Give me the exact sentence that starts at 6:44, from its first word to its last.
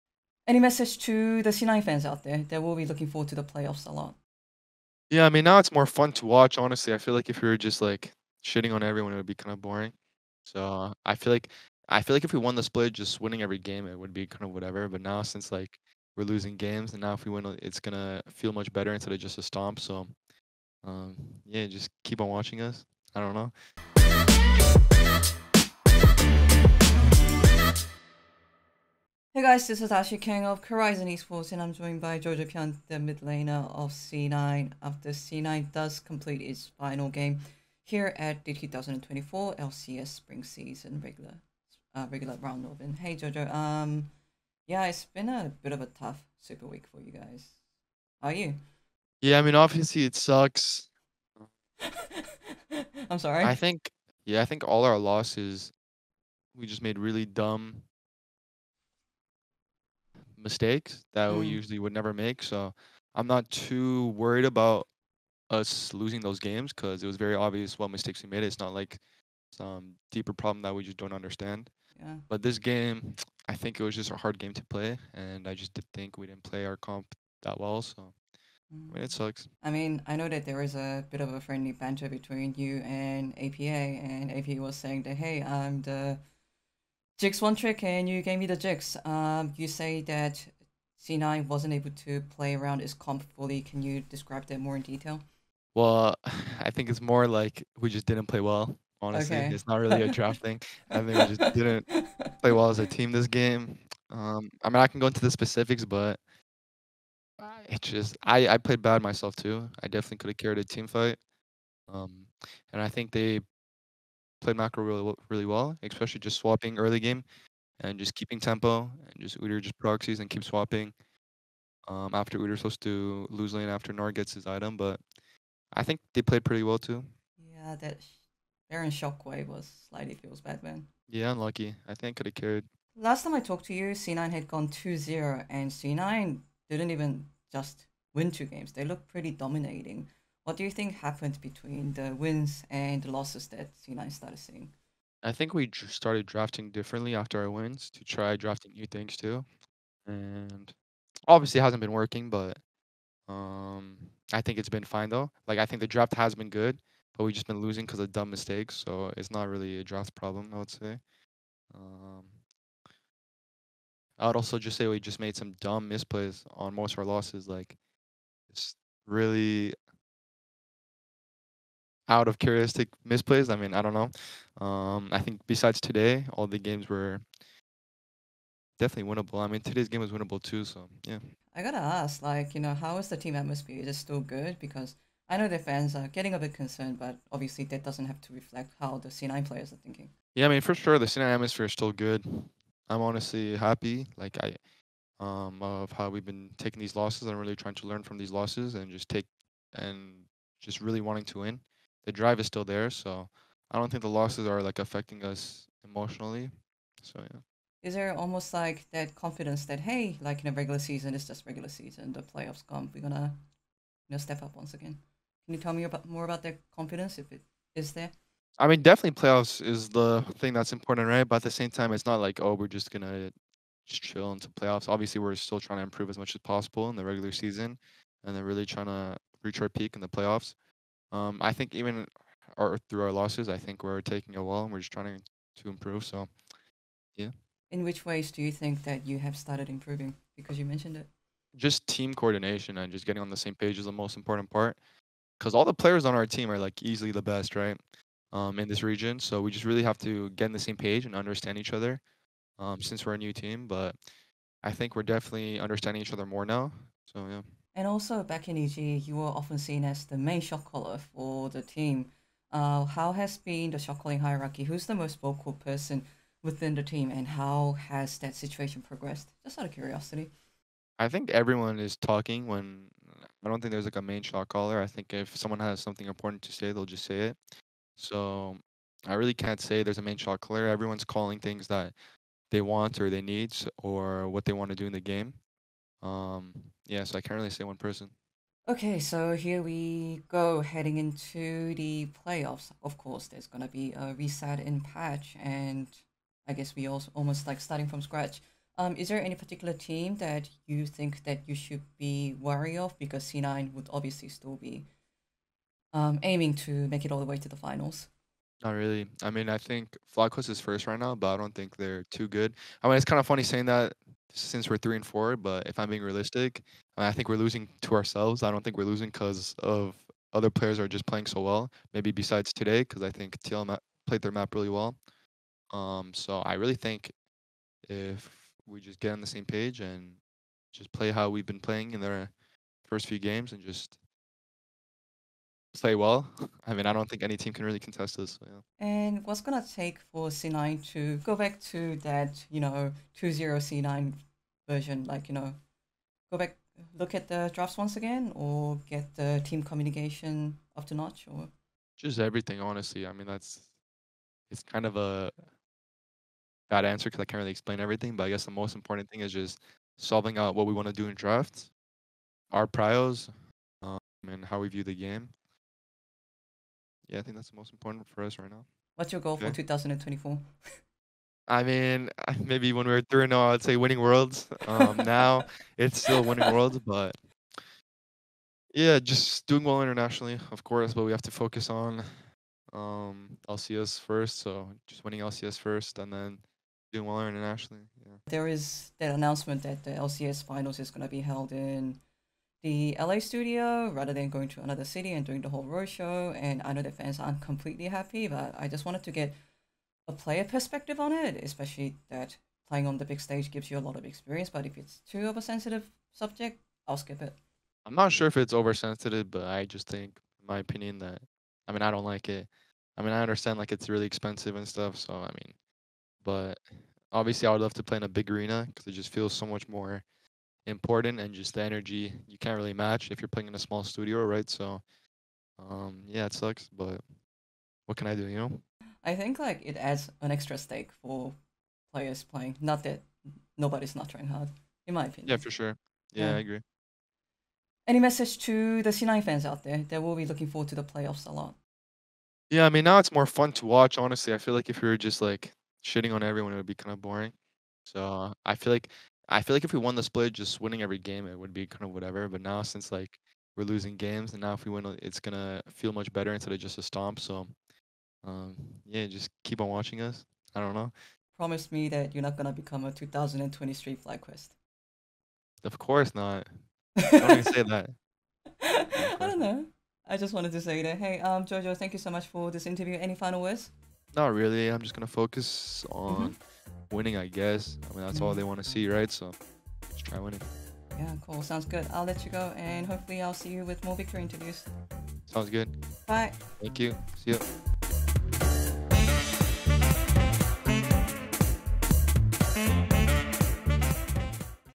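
But if it's too of a sensitive subject, I'll skip it.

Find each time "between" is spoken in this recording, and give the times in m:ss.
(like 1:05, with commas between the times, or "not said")
1:22, 2:21.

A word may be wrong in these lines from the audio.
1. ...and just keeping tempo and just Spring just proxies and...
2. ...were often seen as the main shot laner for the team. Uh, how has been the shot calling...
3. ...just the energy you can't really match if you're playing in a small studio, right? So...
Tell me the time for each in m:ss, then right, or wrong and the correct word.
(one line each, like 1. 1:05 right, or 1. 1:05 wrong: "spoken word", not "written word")
1. 1:57 wrong: "Udyr", not "Spring"
2. 4:19 wrong: "caller", not "laner"
3. 7:01 right.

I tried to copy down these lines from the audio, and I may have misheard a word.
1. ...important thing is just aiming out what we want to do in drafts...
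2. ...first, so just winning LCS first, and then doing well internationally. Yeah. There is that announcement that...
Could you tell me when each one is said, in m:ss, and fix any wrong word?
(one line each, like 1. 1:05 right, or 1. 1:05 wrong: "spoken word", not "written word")
1. 5:58 wrong: "solving", not "aiming"
2. 6:23 right.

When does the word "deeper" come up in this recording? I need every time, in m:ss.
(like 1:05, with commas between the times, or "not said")
1:10.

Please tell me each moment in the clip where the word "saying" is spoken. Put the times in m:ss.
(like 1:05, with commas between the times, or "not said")
1:24, 5:13.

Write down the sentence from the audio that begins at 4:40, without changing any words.
Everyone's calling things that they want or they need or what they want to do in the game.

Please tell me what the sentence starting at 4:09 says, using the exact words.
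So we just really have to get on the same page and understand each other um, since we're a new team.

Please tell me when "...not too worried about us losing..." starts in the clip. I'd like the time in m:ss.
1:03.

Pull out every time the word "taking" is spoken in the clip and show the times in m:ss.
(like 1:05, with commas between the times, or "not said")
3:16, 3:54.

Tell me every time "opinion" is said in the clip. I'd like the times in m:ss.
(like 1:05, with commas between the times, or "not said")
6:50, 7:15.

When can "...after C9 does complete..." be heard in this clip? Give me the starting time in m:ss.
0:34.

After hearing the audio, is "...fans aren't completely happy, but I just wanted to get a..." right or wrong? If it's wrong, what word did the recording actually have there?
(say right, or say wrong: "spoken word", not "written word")
right.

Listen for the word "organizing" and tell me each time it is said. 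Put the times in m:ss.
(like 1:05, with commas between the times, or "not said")
not said.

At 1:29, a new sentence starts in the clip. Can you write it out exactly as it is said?
Um, you say that C9 wasn't able to play around his comp fully.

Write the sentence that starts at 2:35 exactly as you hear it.
Like I think the draft has been good, but we've just been losing because of dumb mistakes.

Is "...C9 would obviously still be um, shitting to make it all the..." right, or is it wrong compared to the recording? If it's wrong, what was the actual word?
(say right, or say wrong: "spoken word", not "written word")
wrong: "aiming", not "shitting".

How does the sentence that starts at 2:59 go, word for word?
I mean, today's game was winnable too.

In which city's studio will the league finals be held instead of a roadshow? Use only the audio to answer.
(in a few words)
LA.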